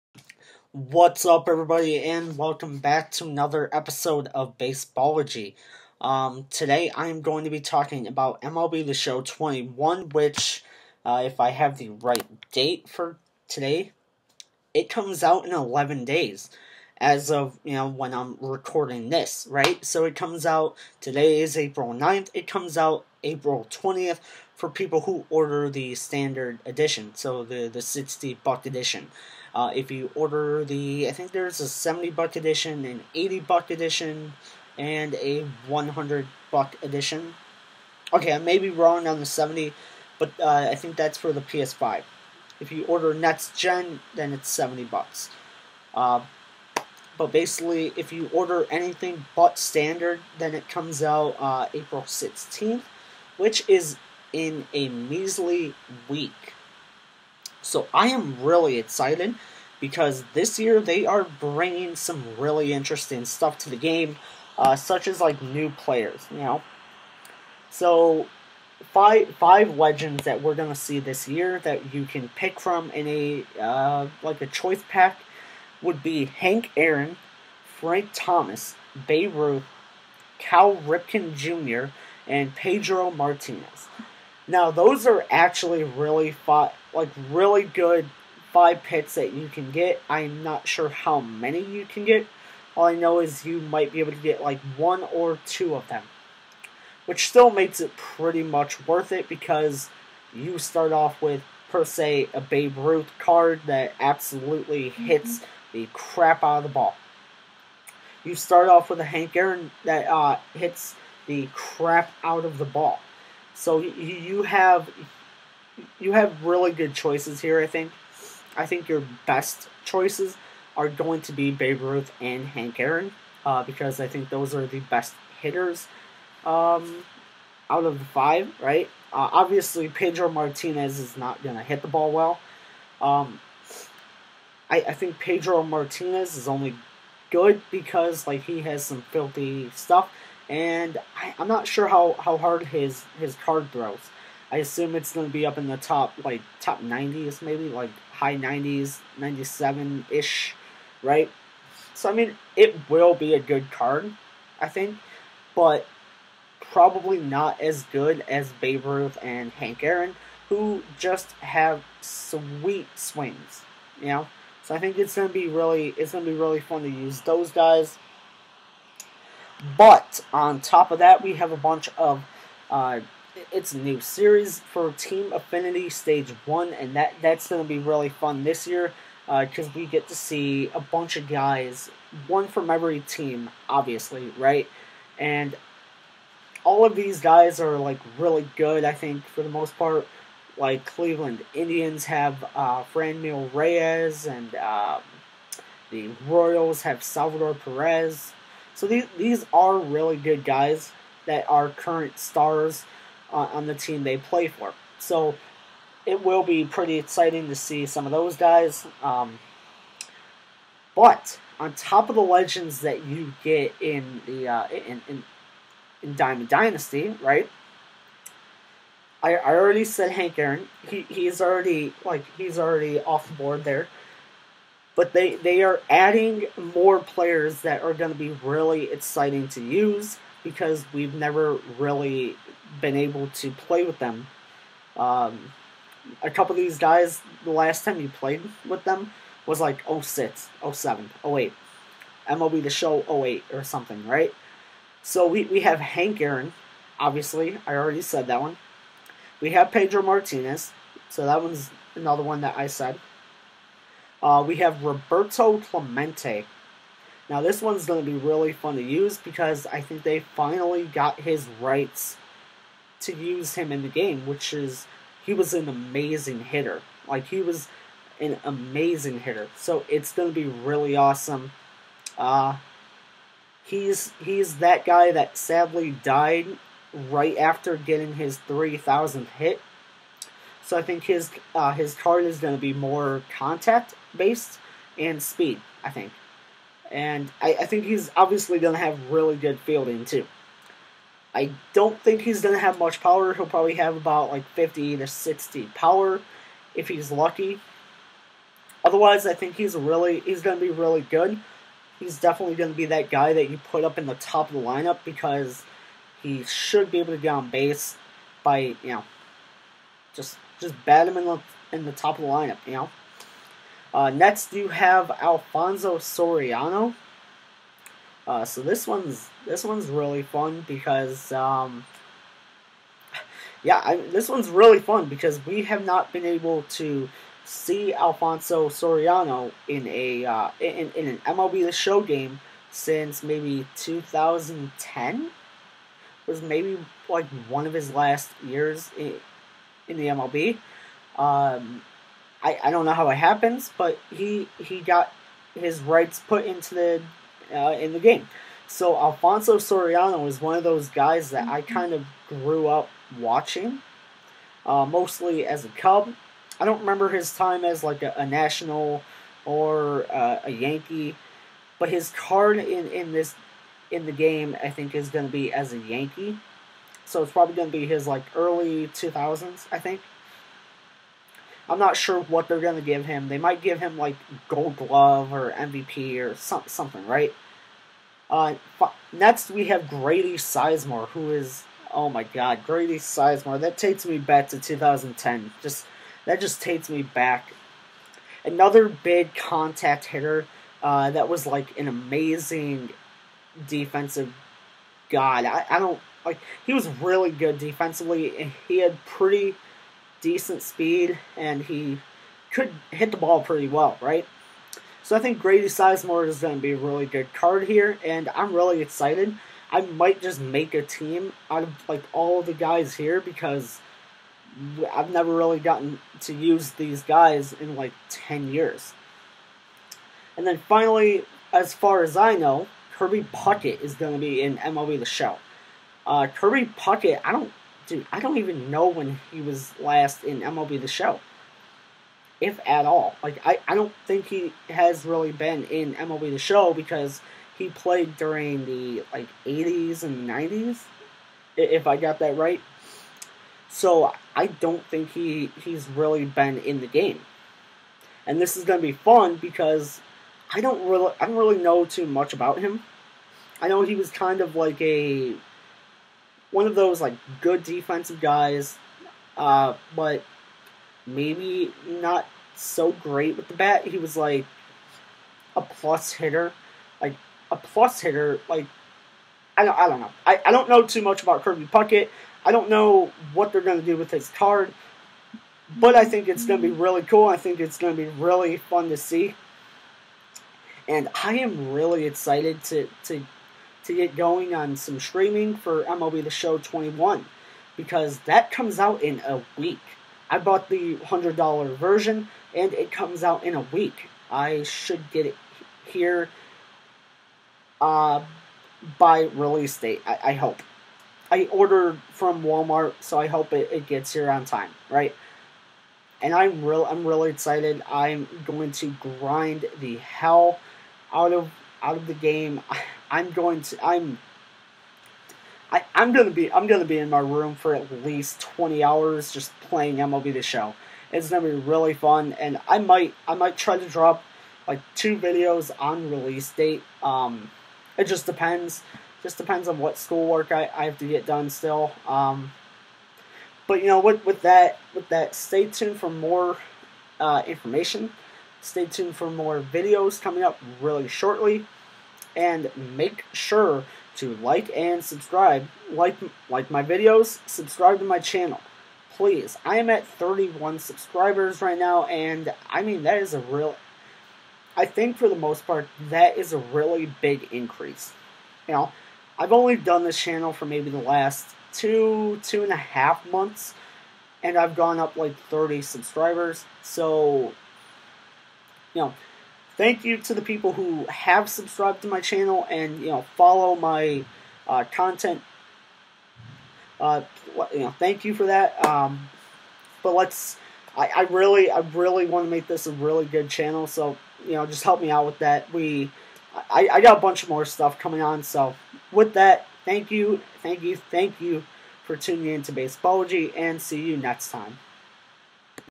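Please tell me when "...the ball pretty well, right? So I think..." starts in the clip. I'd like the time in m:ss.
6:43.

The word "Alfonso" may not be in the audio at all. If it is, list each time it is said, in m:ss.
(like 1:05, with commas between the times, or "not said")
5:15, 5:27, 5:48.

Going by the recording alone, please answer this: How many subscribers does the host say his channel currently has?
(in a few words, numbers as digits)
31.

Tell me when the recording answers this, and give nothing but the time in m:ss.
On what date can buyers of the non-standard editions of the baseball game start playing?
0:51.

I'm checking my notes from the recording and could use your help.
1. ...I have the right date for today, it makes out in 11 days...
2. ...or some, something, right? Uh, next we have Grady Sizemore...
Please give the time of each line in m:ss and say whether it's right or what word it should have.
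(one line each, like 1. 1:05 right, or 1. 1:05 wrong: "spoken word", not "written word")
1. 0:11 wrong: "comes", not "makes"
2. 6:16 right.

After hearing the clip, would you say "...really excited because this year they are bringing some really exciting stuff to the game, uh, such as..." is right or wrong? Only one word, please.
wrong.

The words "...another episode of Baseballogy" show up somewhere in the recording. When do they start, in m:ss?
0:03.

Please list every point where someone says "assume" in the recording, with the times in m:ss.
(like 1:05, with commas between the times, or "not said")
2:24.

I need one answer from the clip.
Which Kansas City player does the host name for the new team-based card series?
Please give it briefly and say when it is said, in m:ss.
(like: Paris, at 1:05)
Salvador Perez, at 3:17.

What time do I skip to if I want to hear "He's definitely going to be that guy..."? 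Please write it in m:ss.
5:01.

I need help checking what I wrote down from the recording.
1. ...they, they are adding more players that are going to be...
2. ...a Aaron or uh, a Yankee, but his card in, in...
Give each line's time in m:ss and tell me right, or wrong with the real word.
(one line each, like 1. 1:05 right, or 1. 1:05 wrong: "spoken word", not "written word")
1. 3:45 right
2. 5:58 wrong: "National", not "Aaron".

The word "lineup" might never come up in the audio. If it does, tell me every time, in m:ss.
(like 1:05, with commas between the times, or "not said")
5:04, 5:12.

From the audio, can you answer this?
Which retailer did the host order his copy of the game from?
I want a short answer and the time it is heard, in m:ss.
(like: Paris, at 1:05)
Walmart, at 8:22.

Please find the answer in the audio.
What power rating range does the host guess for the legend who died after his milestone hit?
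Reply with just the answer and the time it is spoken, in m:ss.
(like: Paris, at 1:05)
50 to 60, at 4:54.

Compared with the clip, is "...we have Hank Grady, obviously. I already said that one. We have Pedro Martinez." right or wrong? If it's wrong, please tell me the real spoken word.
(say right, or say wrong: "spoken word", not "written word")
wrong: "Aaron", not "Grady".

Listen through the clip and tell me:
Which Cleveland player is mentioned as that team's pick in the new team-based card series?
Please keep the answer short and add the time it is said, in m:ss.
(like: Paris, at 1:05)
Franmil Reyes, at 3:12.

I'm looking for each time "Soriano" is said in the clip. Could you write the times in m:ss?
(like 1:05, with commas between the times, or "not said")
5:15, 5:28, 5:49.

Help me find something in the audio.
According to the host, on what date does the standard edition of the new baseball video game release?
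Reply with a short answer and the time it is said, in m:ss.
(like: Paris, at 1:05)
April 20th, at 0:23.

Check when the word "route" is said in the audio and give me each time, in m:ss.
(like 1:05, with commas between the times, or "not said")
not said.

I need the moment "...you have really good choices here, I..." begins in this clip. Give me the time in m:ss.
1:55.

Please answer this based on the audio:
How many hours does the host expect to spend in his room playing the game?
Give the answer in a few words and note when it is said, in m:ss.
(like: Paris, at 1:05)
20, at 8:38.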